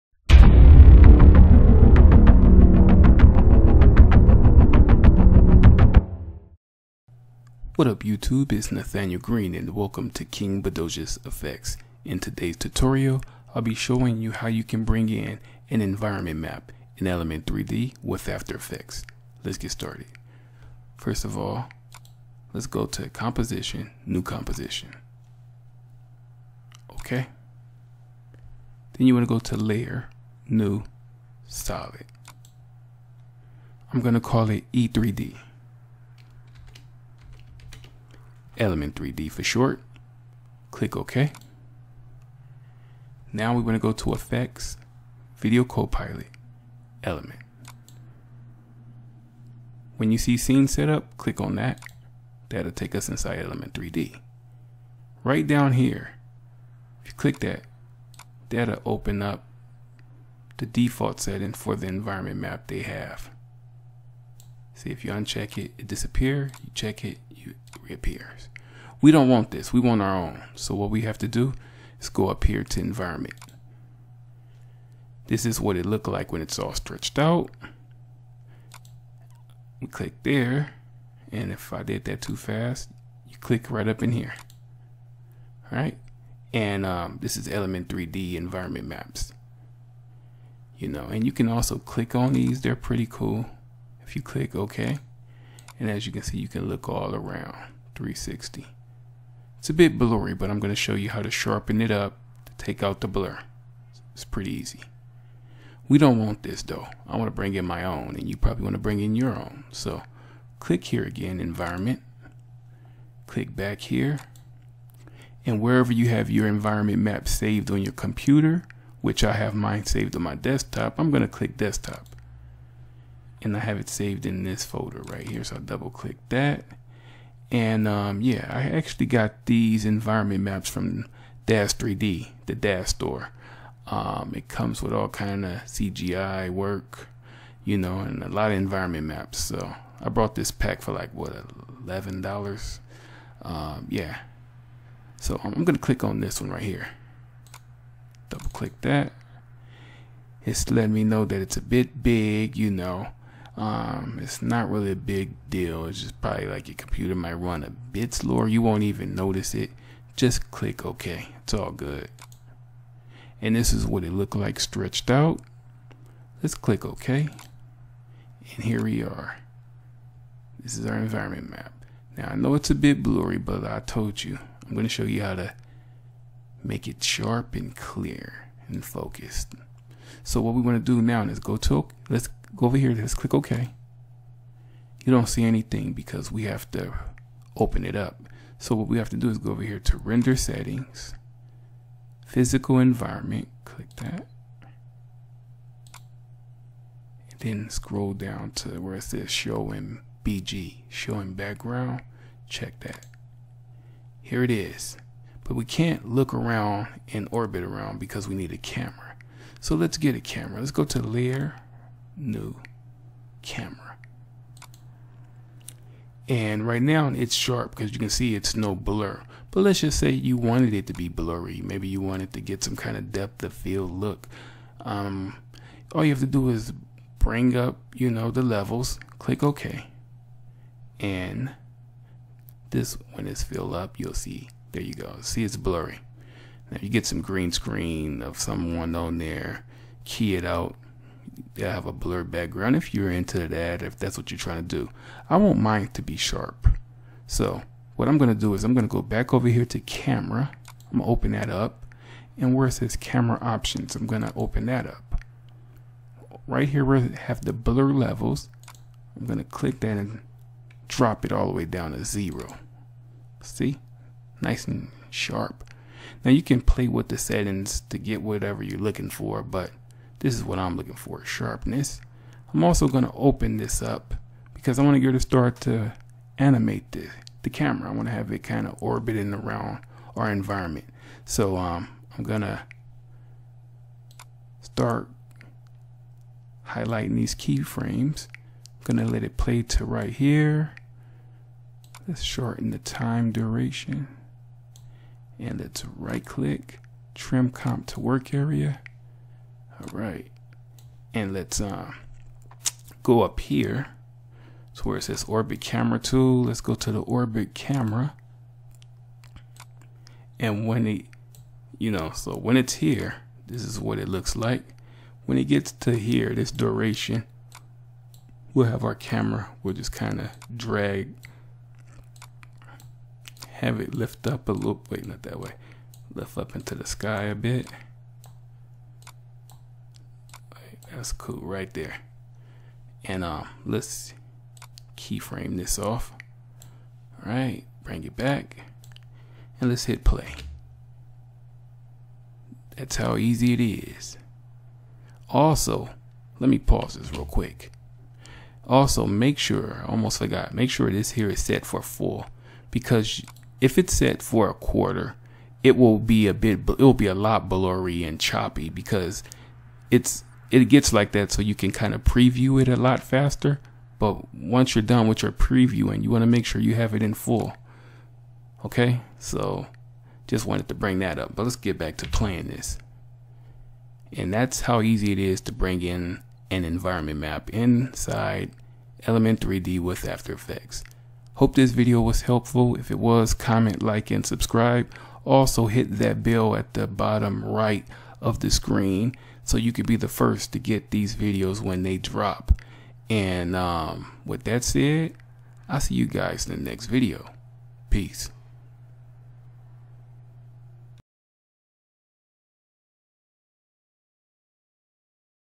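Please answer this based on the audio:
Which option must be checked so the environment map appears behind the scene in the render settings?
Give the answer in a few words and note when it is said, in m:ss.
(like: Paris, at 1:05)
Show in BG, at 3:19.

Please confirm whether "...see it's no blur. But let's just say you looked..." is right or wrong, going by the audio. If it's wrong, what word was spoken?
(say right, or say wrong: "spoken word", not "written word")
wrong: "wanted", not "looked".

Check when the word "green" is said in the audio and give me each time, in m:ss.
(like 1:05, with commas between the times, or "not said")
0:09, 3:57.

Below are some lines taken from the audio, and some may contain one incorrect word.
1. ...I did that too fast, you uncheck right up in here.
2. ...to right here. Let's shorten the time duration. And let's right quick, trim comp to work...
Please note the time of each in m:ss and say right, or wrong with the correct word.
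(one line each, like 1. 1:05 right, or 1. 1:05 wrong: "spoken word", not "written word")
1. 1:21 wrong: "click", not "uncheck"
2. 4:49 wrong: "click", not "quick".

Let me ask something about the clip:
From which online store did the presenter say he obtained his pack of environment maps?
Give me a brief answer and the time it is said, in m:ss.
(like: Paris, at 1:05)
Dash 3D, at 2:11.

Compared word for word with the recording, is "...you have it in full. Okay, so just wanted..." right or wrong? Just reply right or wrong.
right.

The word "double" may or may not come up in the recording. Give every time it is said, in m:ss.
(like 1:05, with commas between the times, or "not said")
2:05, 2:28.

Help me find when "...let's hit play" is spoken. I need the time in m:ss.
5:39.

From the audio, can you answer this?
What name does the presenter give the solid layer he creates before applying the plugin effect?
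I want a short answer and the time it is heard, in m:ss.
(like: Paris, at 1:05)
E3D, at 0:34.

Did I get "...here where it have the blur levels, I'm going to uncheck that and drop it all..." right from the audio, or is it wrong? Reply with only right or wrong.
wrong.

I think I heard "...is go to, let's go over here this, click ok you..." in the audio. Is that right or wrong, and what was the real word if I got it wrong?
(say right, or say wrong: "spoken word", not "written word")
right.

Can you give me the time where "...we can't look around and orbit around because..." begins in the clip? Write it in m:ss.
3:25.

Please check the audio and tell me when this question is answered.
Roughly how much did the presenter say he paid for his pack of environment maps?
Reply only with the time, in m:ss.
2:21.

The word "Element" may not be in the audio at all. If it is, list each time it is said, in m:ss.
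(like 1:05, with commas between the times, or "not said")
0:17, 0:38, 0:47, 0:53, 1:27, 6:19.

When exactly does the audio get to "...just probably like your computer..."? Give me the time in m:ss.
2:36.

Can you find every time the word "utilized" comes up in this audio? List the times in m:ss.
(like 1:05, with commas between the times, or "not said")
not said.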